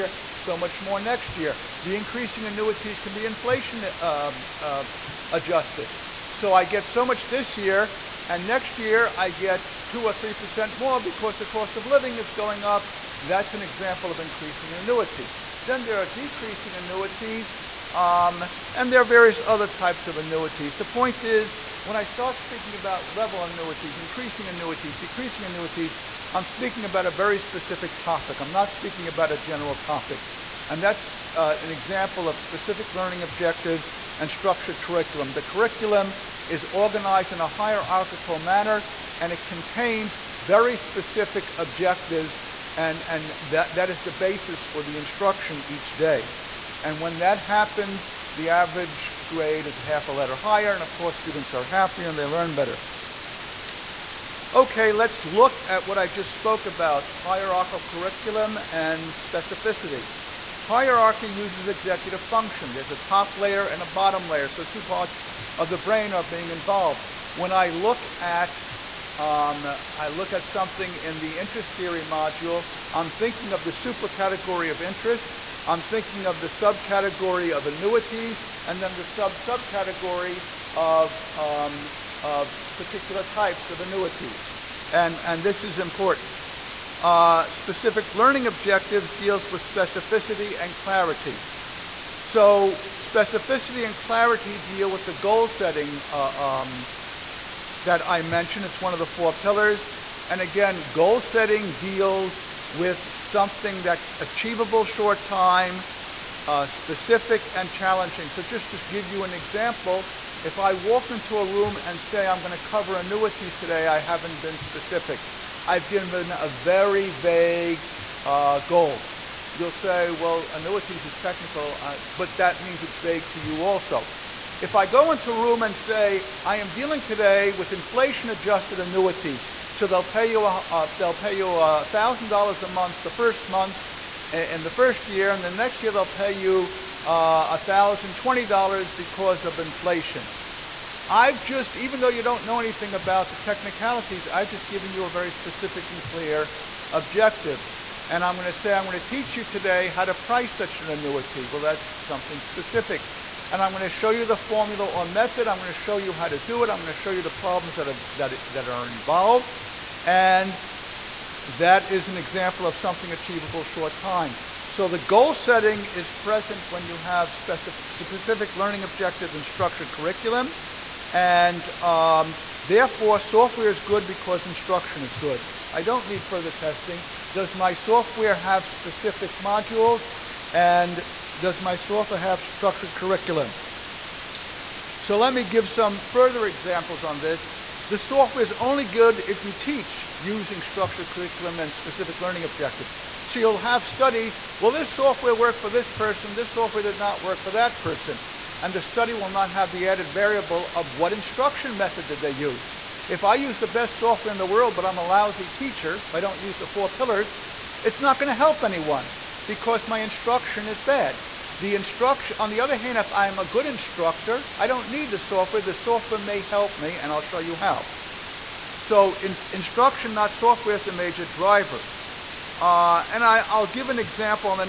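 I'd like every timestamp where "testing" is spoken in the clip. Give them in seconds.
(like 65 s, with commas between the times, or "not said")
176 s.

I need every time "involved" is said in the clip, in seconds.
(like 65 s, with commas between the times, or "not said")
66 s, 158 s.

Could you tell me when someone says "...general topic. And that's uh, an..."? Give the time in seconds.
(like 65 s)
29 s.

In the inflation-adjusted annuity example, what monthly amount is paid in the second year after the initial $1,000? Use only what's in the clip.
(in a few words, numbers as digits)
$1,020.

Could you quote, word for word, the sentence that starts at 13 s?
That's an example of increasing an annuity.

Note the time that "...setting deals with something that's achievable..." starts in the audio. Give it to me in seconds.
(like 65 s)
101 s.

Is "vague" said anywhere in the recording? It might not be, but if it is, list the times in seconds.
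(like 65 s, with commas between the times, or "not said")
117 s, 122 s.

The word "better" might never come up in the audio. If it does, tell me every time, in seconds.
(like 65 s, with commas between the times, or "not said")
52 s.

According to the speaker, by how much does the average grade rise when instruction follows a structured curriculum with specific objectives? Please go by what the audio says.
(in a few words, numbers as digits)
half a letter.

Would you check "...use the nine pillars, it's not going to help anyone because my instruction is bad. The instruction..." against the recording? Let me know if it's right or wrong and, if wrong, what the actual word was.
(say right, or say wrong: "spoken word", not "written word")
wrong: "four", not "nine".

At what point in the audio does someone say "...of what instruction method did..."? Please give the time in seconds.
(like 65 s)
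200 s.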